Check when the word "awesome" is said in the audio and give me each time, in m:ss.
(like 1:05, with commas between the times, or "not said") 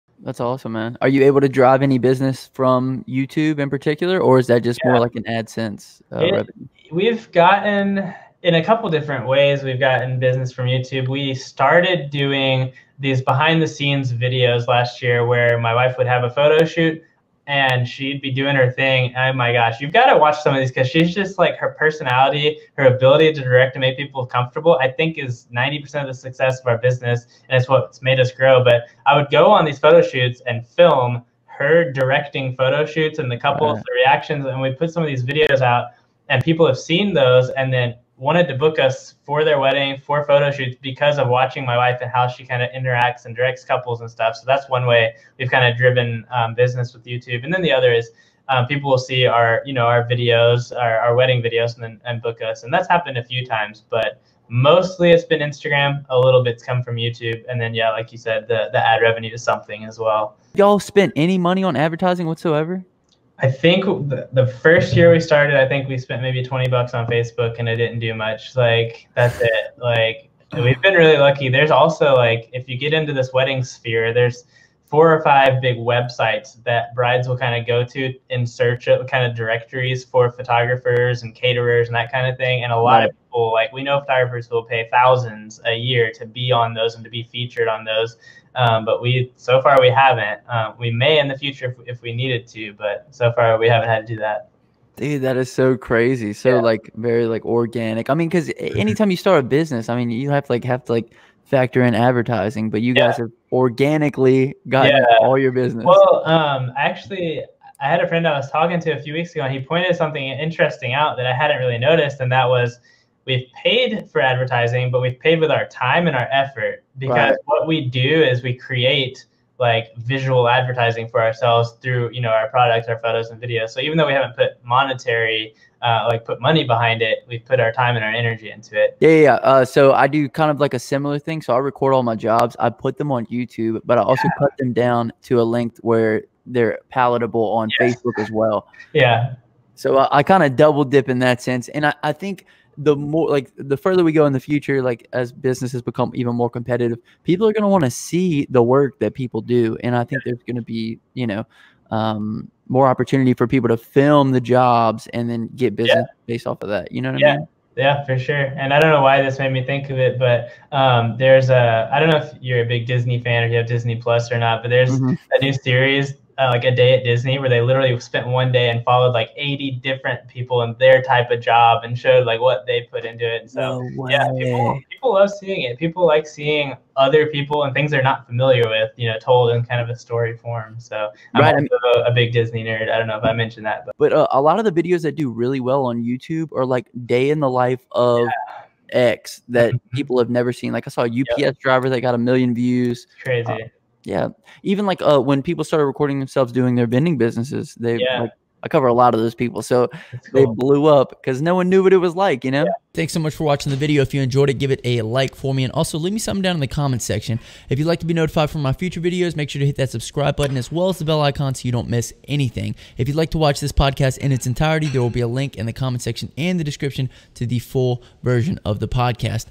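0:00.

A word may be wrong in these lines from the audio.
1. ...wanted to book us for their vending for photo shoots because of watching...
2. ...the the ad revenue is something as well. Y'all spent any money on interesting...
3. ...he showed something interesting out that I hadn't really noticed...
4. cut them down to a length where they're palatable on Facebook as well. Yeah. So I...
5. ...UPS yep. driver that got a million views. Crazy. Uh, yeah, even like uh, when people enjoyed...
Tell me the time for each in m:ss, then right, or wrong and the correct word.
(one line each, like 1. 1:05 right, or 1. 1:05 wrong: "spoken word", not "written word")
1. 0:38 wrong: "wedding", not "vending"
2. 0:58 wrong: "advertising", not "interesting"
3. 1:49 wrong: "pointed", not "showed"
4. 2:14 right
5. 3:11 wrong: "started", not "enjoyed".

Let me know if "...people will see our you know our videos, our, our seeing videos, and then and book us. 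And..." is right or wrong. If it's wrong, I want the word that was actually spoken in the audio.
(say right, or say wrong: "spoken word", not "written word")
wrong: "wedding", not "seeing".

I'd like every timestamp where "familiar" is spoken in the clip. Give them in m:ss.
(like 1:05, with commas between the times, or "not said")
2:58.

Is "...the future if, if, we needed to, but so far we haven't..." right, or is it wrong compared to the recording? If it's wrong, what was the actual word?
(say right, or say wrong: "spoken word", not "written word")
right.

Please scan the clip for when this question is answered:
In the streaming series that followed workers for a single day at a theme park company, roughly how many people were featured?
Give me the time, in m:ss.
2:49.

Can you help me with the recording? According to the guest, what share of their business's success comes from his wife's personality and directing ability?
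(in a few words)
90 percent.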